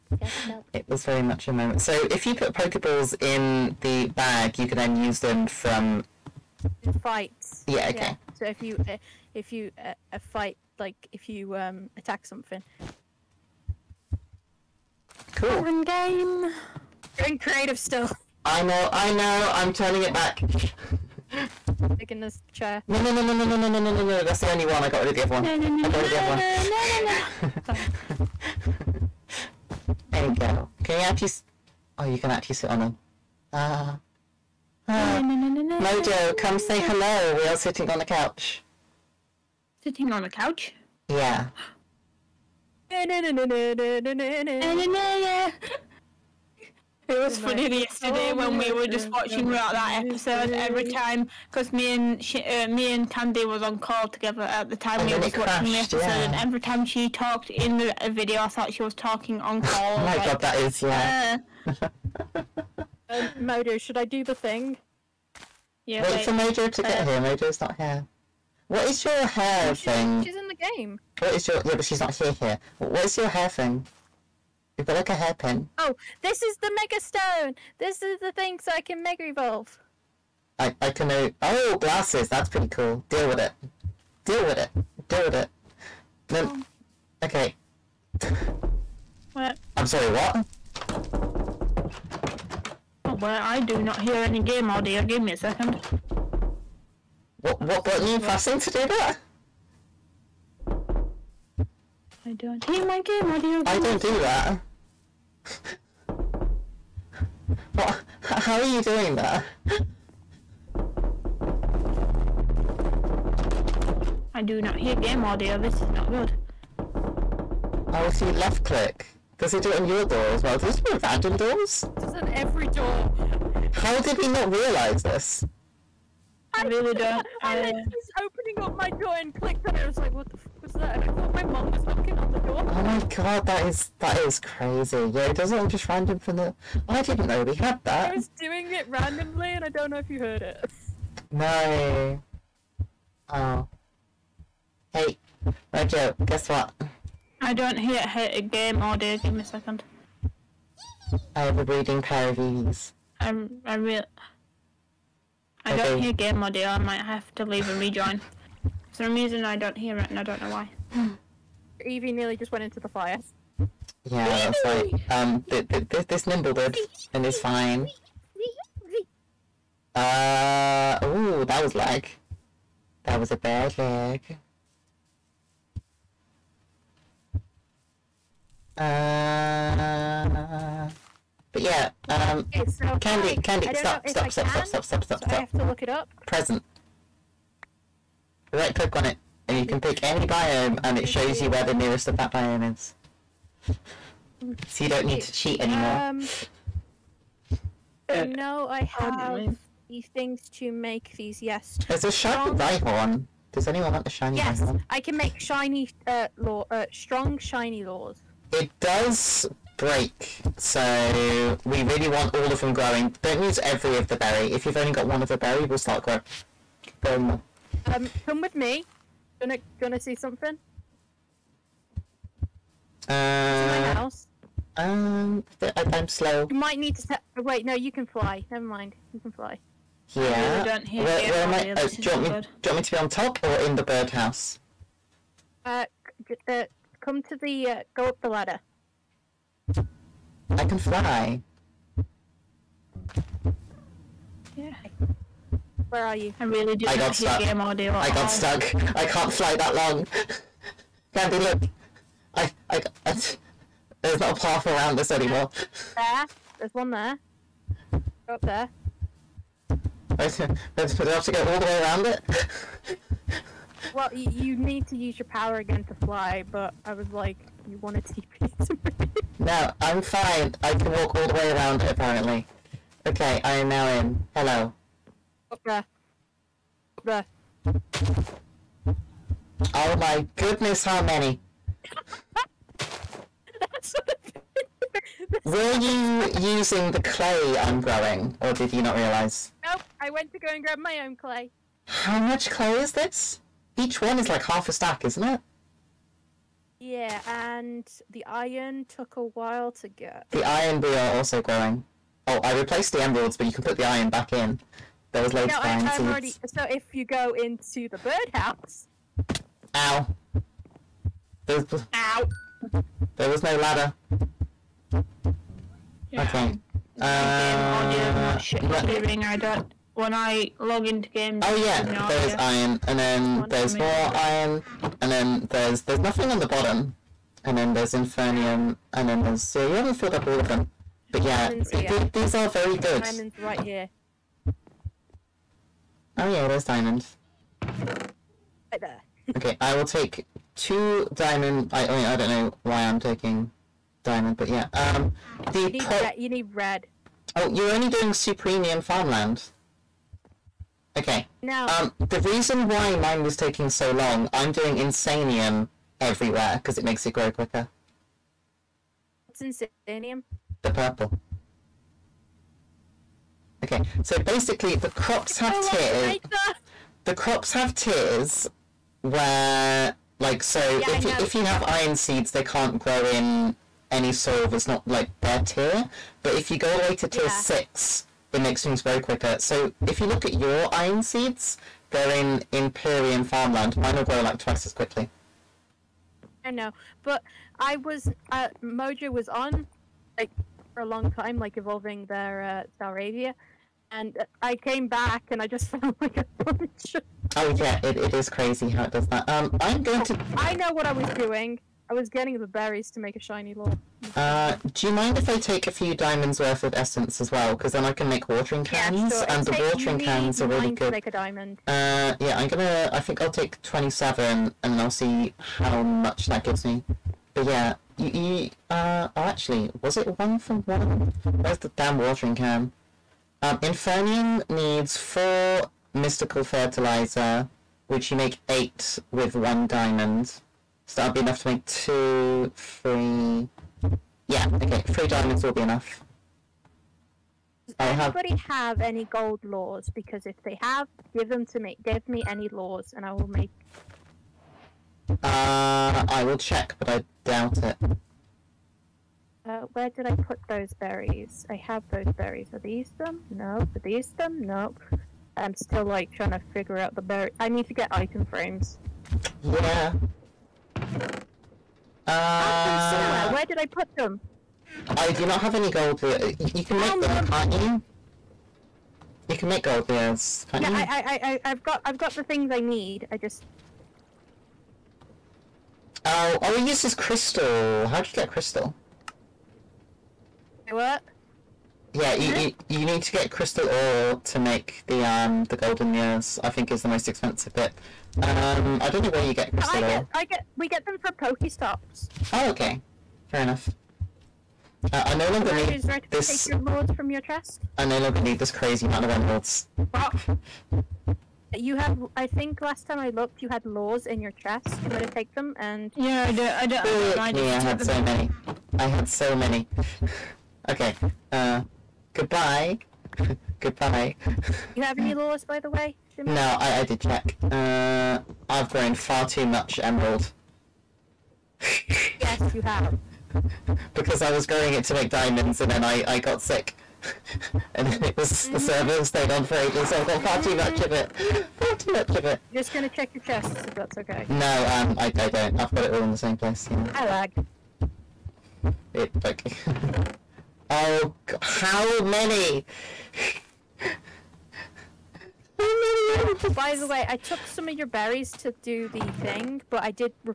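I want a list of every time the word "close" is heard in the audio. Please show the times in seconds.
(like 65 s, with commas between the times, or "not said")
not said.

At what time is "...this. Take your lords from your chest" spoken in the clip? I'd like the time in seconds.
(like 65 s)
496 s.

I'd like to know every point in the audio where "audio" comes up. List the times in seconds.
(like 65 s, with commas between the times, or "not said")
94 s, 103 s, 115 s, 148 s, 156 s, 247 s, 317 s.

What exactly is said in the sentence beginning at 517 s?
Uh, I've grown far too much emerald.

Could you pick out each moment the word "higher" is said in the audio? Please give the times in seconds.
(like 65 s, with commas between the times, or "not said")
not said.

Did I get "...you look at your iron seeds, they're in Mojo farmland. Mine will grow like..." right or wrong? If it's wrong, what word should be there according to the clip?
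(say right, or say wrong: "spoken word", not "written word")
wrong: "Imperium", not "Mojo".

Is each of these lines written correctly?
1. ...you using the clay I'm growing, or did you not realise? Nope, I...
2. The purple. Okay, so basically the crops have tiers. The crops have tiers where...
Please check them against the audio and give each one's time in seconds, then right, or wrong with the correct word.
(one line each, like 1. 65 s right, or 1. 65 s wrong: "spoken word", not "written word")
1. 285 s right
2. 360 s right.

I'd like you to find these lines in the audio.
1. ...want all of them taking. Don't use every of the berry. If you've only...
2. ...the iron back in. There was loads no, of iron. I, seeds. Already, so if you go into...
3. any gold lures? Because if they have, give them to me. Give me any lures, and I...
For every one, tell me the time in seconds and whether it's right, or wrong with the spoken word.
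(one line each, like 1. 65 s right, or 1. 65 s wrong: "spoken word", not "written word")
1. 212 s wrong: "growing", not "taking"
2. 303 s right
3. 438 s right.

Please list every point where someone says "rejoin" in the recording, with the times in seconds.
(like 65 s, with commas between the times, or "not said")
157 s.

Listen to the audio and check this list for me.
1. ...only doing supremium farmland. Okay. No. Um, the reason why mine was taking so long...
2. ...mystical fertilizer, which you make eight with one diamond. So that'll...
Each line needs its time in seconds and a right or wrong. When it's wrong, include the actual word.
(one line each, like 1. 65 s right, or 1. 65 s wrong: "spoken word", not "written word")
1. 347 s right
2. 425 s right.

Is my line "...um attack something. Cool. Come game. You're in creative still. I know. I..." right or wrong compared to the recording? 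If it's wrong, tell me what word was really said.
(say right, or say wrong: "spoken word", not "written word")
right.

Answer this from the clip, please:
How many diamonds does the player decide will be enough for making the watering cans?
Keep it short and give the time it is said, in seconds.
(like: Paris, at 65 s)
3, at 434 s.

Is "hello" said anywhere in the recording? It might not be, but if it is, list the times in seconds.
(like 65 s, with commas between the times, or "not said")
36 s, 274 s.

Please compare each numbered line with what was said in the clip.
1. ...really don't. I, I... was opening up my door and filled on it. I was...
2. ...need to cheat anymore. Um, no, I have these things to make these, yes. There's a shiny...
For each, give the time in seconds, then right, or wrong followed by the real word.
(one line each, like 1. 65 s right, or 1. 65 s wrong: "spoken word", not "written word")
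1. 126 s wrong: "clicked", not "filled"
2. 195 s right.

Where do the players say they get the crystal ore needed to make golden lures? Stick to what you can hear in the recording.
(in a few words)
Pokestops.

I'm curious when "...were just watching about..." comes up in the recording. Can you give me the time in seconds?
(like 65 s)
48 s.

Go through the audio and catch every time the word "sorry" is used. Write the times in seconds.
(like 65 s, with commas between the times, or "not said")
89 s.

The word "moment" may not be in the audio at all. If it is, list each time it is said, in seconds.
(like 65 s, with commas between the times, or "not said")
1 s.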